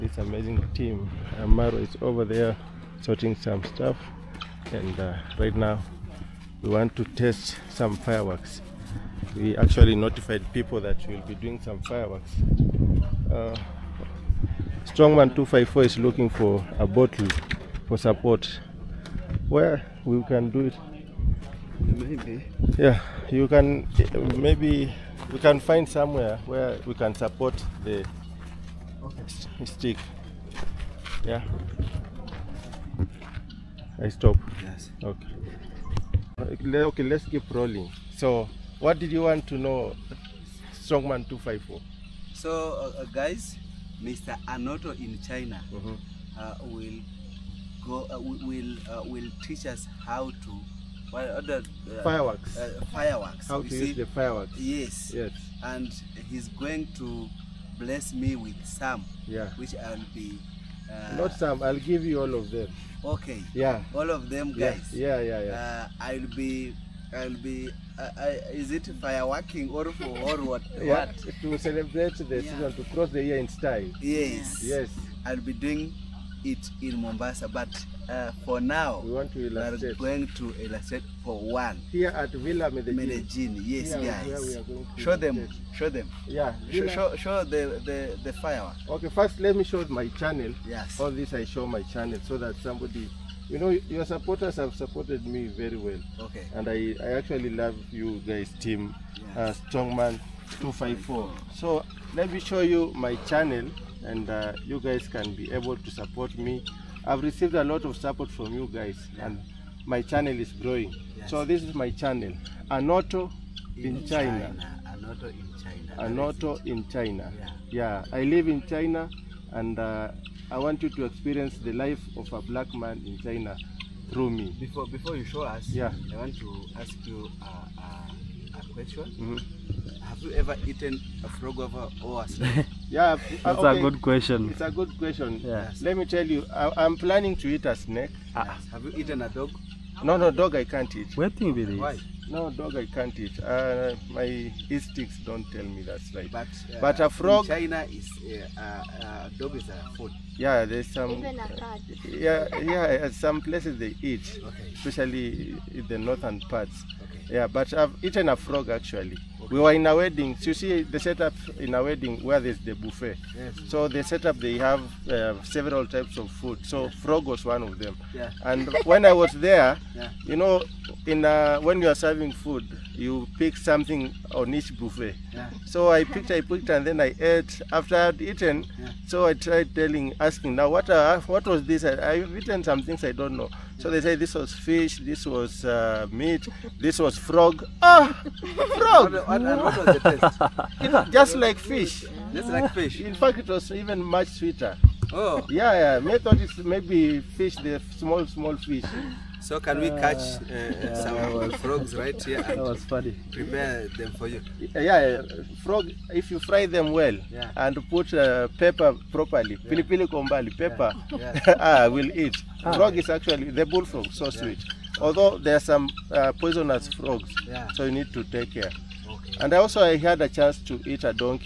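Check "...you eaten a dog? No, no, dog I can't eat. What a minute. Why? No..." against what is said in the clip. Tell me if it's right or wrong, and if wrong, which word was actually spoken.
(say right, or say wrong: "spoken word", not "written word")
right.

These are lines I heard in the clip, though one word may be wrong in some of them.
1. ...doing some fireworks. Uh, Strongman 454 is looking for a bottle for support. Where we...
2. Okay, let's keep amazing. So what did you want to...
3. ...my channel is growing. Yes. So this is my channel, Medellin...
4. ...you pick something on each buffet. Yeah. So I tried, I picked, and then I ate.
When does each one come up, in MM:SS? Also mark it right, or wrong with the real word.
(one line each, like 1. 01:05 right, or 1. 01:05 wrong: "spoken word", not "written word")
1. 00:11 wrong: "254", not "454"
2. 00:36 wrong: "rolling", not "amazing"
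3. 01:49 wrong: "Anoto", not "Medellin"
4. 02:52 wrong: "picked", not "tried".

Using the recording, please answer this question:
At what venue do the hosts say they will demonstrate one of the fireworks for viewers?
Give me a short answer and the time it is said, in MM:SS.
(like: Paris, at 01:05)
Villa Medellin, at 01:22.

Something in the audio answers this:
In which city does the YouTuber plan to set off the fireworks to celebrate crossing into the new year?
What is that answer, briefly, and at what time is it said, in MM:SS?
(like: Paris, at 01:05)
Mombasa, at 01:17.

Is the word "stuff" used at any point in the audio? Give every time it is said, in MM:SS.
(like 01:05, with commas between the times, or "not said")
00:03.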